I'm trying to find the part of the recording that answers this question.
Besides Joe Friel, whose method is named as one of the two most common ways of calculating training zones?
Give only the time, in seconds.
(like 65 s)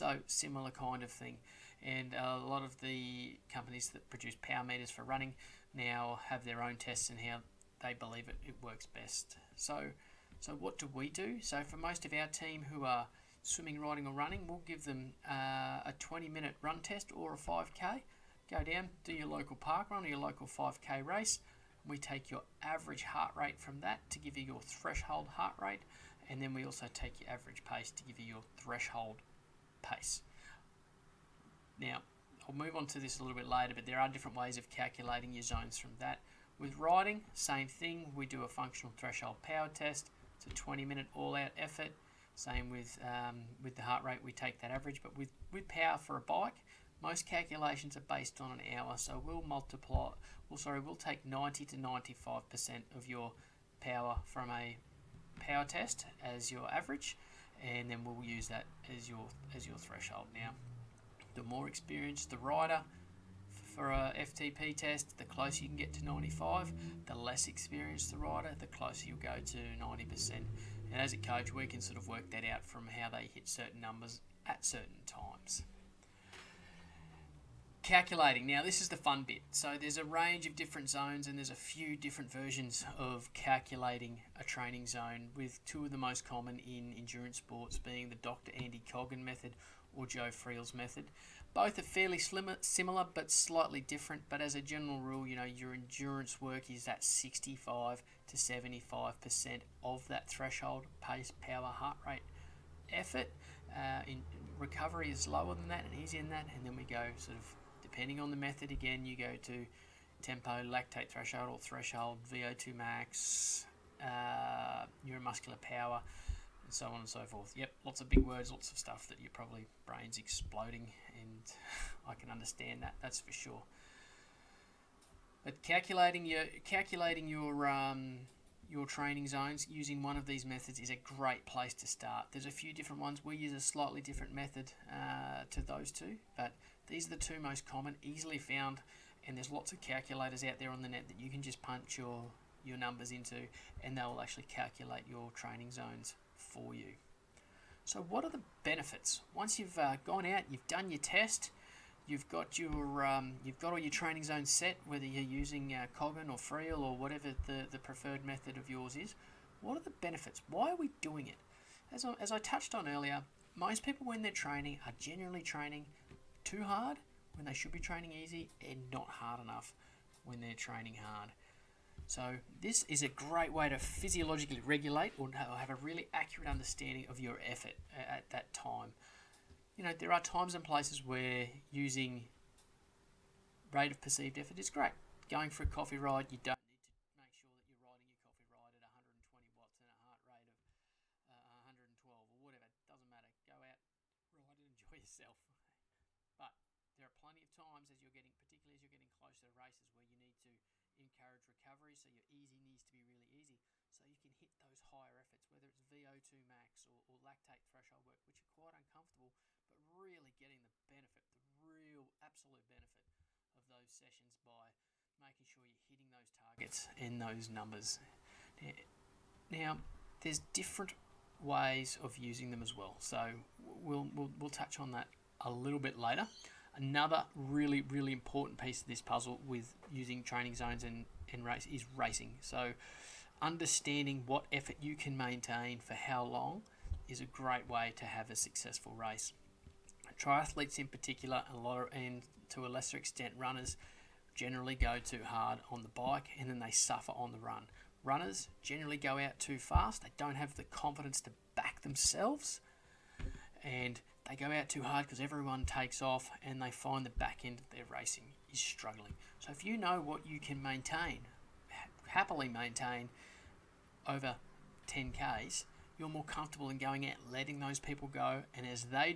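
88 s.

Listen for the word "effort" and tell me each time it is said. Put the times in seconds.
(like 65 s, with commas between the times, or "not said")
41 s, 102 s, 177 s, 184 s, 205 s, 234 s.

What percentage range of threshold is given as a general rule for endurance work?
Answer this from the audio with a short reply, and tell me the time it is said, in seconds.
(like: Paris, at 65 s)
65 to 75%, at 97 s.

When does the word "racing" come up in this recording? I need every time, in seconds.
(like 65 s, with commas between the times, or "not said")
231 s, 257 s.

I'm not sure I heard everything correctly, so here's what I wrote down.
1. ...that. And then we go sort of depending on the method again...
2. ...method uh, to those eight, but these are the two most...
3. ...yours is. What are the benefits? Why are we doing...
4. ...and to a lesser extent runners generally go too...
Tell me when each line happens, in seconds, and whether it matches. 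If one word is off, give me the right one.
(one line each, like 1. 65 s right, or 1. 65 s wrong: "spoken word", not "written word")
1. 106 s right
2. 134 s wrong: "two", not "eight"
3. 158 s right
4. 241 s right.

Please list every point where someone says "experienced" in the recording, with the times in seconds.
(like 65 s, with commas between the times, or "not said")
61 s, 67 s.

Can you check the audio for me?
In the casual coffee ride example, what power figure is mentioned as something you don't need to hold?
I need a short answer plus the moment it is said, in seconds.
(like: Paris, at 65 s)
120 watts, at 188 s.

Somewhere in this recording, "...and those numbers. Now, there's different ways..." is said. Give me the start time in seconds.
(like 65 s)
216 s.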